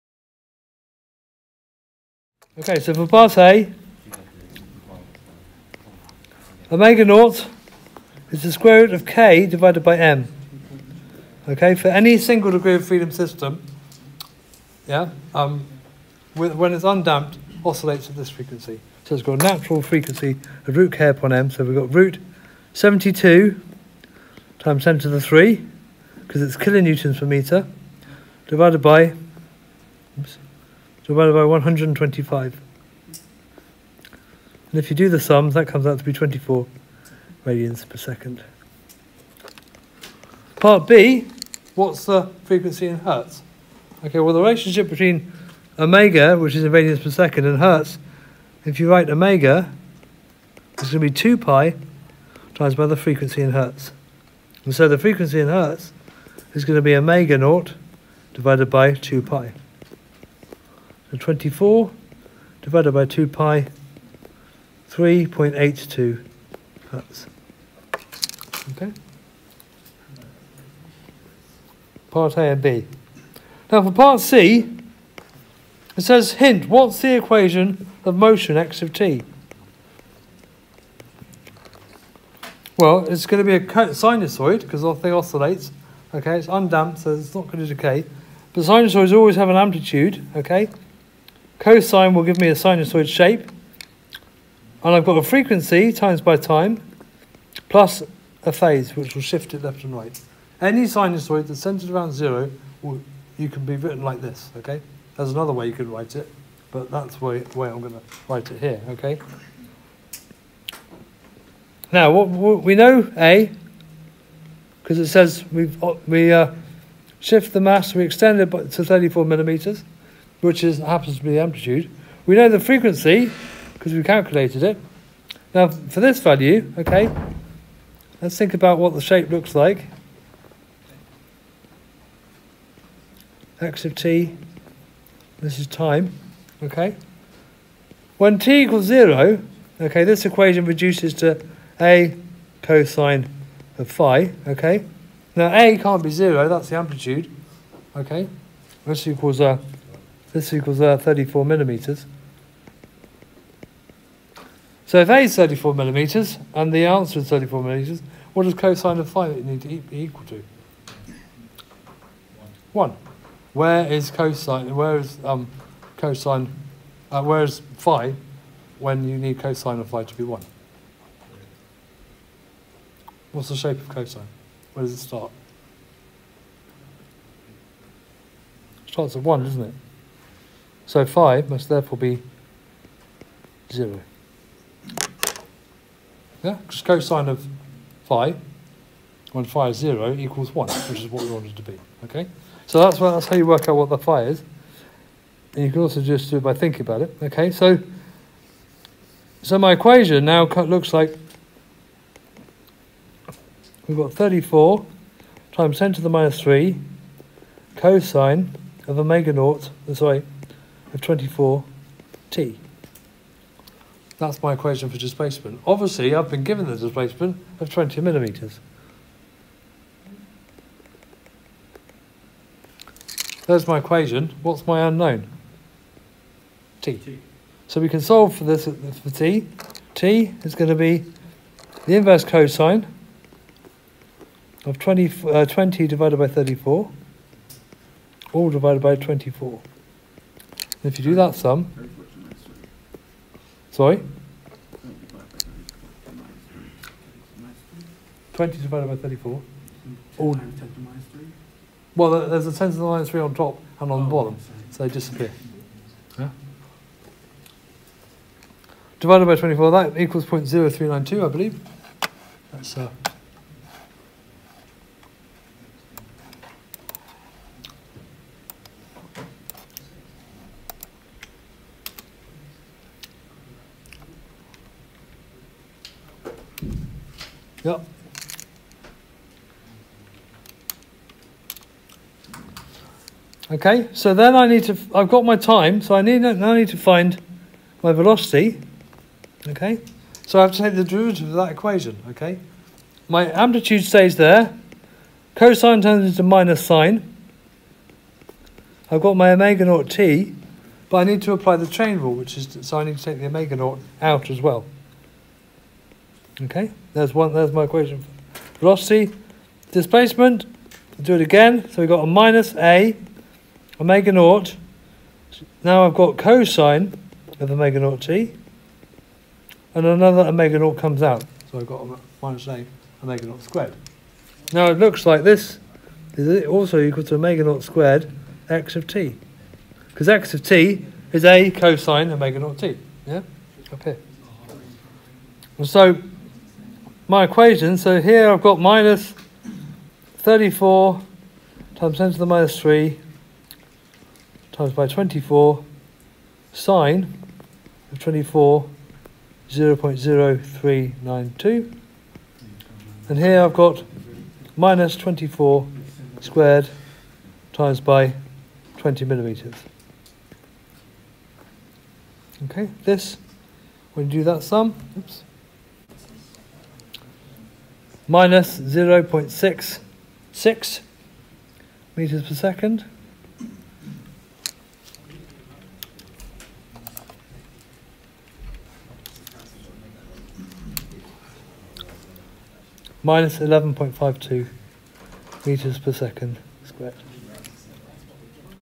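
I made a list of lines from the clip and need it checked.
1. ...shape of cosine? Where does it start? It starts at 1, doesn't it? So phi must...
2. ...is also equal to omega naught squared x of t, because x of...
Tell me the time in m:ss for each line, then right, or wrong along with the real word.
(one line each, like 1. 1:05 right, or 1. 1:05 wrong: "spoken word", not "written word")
1. 2:53 right
2. 5:26 right.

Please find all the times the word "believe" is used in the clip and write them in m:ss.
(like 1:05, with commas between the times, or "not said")
4:21.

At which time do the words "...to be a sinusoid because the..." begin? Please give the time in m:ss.
1:23.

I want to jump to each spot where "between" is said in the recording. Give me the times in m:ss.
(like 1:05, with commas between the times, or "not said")
0:44.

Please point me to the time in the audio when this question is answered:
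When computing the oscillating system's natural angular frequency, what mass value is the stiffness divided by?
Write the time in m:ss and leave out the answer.
0:31.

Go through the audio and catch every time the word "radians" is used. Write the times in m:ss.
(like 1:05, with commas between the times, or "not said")
0:37, 0:46.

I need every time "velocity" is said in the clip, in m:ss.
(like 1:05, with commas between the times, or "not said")
4:47, 5:08.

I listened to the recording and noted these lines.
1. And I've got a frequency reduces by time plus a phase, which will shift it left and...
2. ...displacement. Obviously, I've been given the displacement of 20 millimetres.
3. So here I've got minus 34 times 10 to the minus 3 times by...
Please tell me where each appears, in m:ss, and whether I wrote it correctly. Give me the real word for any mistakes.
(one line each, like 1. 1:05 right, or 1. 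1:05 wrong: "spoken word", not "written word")
1. 1:34 wrong: "times", not "reduces"
2. 3:34 right
3. 5:37 right.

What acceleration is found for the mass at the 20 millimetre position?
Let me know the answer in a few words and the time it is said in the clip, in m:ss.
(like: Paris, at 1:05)
-11.52 m/s², at 6:23.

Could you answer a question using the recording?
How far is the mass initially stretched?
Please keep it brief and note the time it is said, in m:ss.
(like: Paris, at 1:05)
34 millimeters, at 1:58.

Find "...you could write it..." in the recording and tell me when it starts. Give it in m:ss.
1:45.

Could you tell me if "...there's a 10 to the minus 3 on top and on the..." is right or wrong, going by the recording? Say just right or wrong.
right.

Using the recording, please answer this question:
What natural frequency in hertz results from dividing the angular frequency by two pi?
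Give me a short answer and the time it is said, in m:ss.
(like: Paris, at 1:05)
3.82 hertz, at 1:04.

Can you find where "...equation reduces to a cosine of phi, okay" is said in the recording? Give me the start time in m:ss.
2:20.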